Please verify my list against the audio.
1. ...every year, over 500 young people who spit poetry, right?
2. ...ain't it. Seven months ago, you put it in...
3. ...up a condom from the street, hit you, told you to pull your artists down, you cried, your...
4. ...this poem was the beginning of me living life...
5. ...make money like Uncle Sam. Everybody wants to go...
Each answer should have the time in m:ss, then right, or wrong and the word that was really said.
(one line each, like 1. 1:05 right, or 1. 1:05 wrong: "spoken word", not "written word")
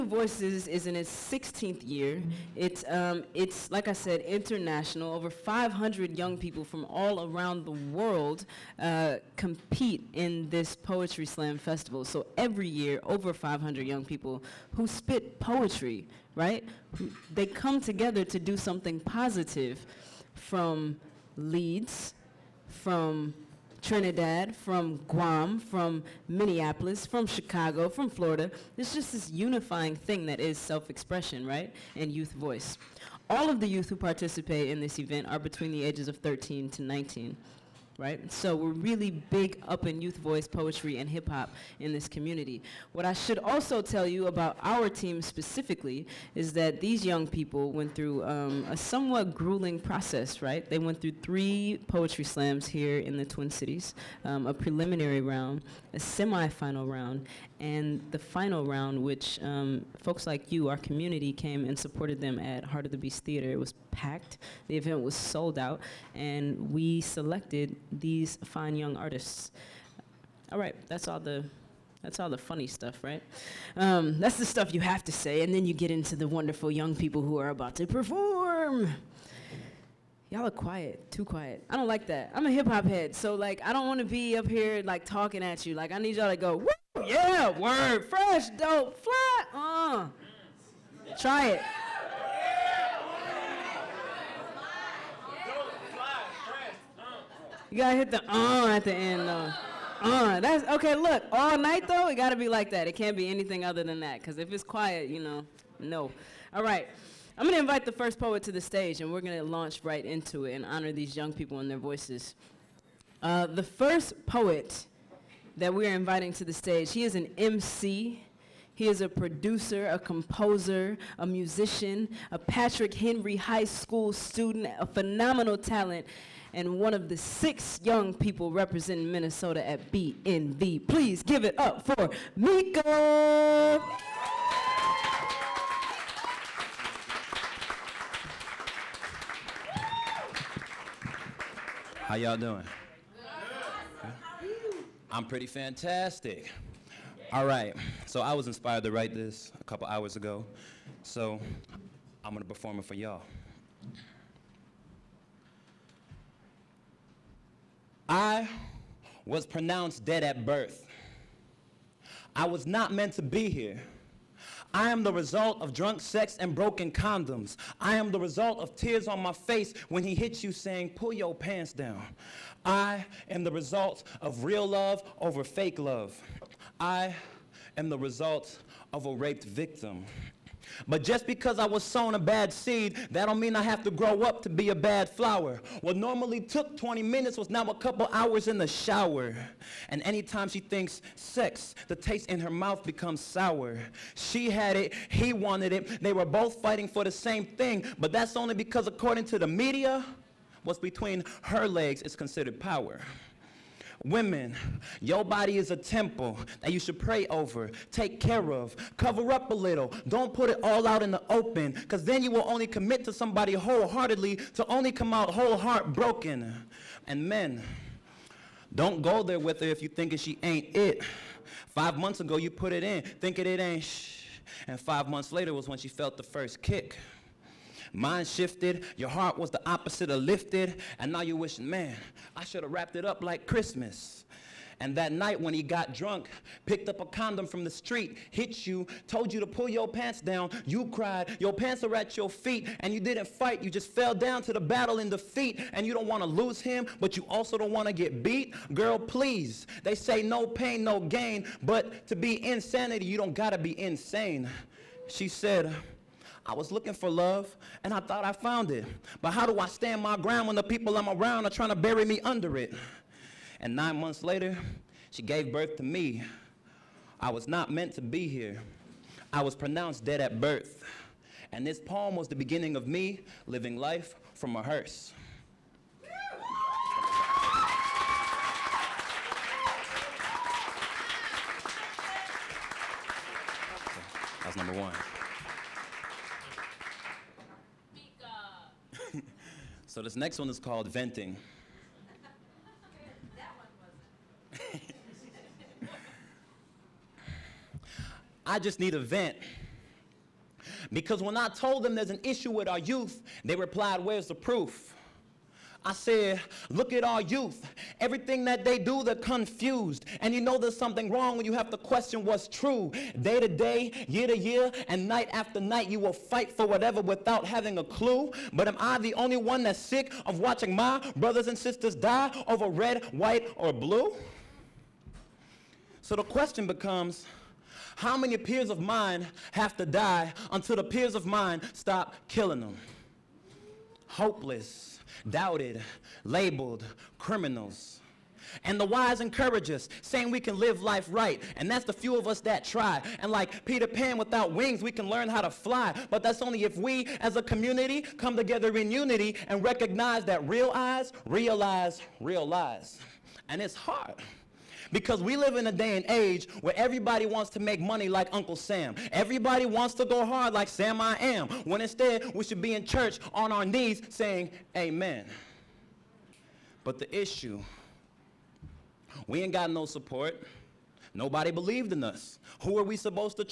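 1. 0:12 right
2. 3:40 wrong: "Five", not "Seven"
3. 3:56 wrong: "pants", not "artists"
4. 4:31 right
5. 5:57 right.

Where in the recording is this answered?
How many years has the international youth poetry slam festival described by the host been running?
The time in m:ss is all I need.
0:01.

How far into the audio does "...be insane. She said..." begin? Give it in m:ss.
4:13.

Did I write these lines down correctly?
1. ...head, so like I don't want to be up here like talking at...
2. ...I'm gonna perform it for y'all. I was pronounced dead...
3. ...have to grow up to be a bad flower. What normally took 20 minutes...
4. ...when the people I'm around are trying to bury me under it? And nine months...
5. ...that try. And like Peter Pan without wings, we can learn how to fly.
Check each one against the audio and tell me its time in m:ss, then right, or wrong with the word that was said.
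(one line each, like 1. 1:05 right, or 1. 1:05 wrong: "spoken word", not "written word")
1. 1:22 right
2. 2:32 right
3. 3:03 right
4. 4:20 right
5. 5:42 right.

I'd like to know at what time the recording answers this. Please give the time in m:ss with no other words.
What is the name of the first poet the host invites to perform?
2:12.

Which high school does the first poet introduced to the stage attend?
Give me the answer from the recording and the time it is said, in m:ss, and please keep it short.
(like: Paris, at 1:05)
Patrick Henry High School, at 2:02.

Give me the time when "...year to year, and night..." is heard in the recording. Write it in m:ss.
5:14.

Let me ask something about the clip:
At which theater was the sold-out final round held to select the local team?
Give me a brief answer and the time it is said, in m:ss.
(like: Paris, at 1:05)
Heart of the Beast Theater, at 1:02.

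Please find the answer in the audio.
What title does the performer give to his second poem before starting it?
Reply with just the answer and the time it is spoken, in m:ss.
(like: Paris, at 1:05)
venting, at 4:50.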